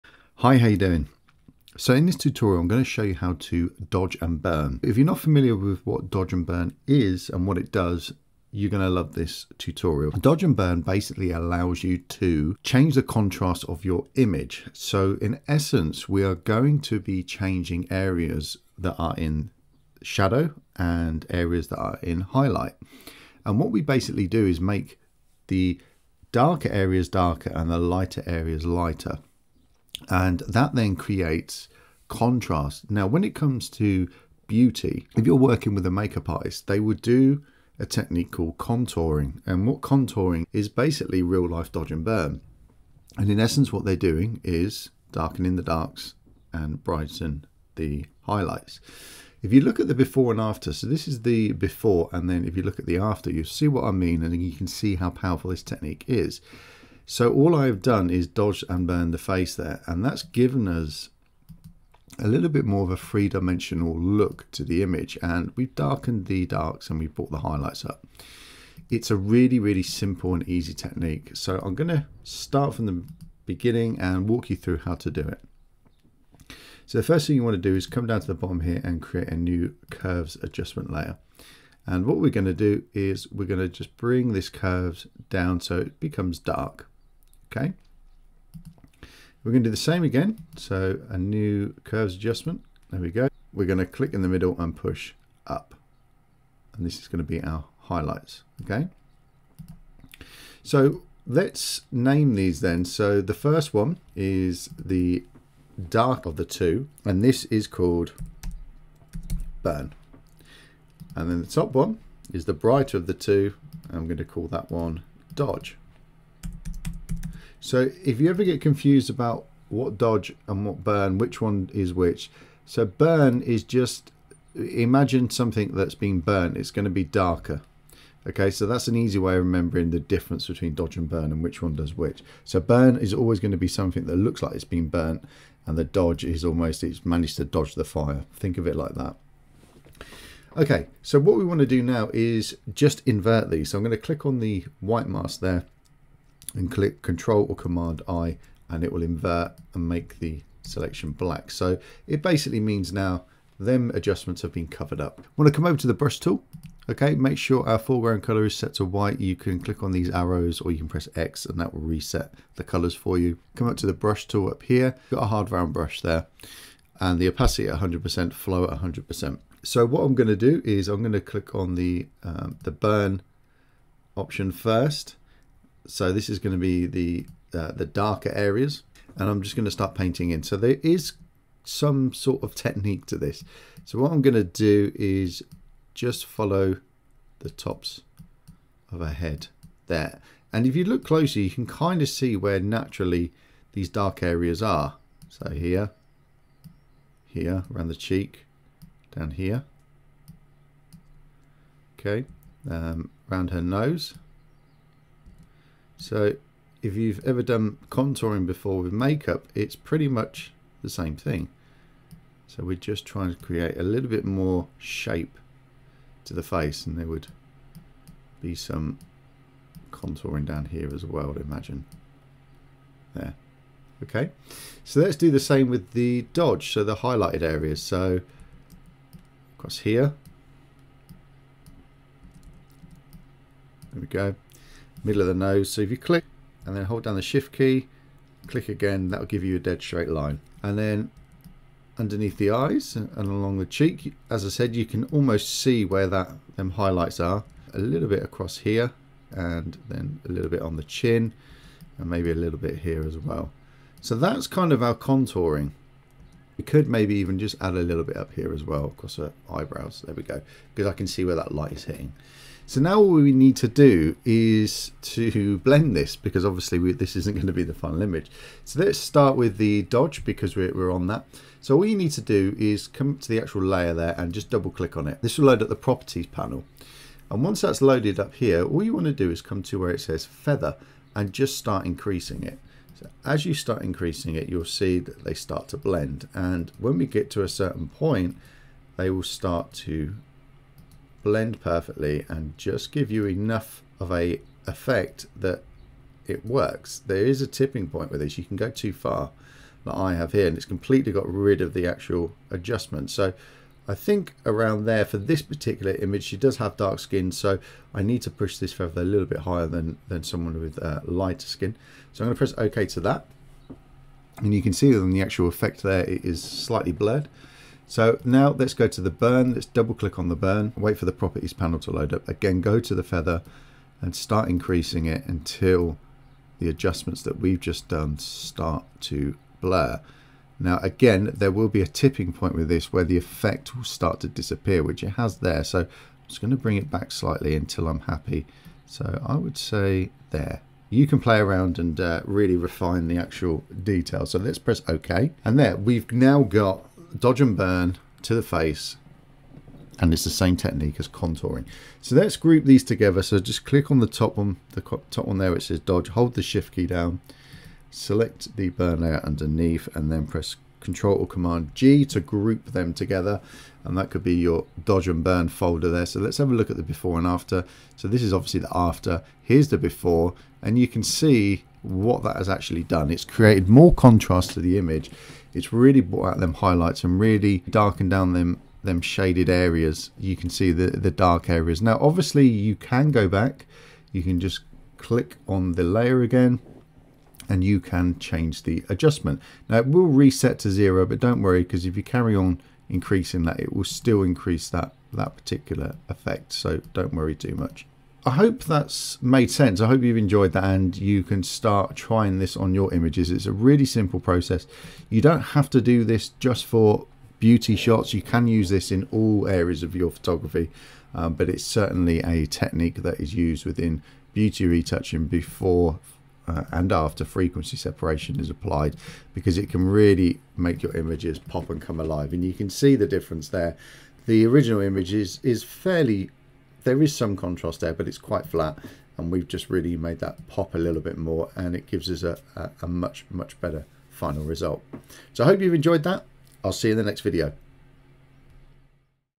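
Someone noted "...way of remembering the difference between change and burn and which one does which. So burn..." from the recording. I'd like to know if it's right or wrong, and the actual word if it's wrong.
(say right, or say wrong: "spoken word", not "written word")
wrong: "dodge", not "change".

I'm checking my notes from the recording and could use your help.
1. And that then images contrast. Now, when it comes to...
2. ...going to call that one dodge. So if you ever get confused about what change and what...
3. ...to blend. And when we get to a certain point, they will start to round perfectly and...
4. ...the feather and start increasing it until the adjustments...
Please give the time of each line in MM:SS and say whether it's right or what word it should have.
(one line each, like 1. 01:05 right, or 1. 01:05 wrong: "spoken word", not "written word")
1. 00:30 wrong: "creates", not "images"
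2. 01:54 wrong: "dodge", not "change"
3. 04:45 wrong: "blend", not "round"
4. 05:22 right.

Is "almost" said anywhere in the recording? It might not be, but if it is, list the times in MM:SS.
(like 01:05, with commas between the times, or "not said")
02:16, 04:05.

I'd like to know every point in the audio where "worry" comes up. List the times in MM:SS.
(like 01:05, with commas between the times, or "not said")
06:31, 06:37.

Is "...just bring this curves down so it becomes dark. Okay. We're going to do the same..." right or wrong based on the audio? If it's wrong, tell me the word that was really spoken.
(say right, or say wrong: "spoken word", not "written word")
right.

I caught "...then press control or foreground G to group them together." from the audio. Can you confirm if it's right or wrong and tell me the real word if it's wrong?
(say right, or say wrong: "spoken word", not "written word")
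wrong: "command", not "foreground".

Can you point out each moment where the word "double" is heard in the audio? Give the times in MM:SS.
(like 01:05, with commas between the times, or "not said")
04:34, 05:19.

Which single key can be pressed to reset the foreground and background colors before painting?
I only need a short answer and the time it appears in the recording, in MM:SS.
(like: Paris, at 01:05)
X, at 02:41.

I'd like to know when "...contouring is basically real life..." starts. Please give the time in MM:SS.
00:39.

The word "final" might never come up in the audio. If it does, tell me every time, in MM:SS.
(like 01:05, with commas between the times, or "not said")
04:27, 07:14.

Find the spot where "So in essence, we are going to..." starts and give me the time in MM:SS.
00:14.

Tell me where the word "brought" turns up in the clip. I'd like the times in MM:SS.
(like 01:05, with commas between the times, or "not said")
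01:07, 06:16.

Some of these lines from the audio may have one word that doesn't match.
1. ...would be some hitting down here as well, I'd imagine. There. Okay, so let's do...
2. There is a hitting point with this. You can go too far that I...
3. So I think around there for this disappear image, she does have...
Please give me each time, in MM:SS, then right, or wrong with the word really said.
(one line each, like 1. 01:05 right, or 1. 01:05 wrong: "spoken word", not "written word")
1. 03:37 wrong: "contouring", not "hitting"
2. 04:57 wrong: "tipping", not "hitting"
3. 05:03 wrong: "particular", not "disappear".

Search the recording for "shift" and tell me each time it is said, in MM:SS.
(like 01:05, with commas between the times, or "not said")
03:57, 05:56.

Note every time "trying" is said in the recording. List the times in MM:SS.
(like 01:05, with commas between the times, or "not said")
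03:33, 06:41.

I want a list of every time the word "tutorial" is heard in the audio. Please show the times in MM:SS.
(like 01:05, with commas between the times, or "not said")
00:02, 00:09.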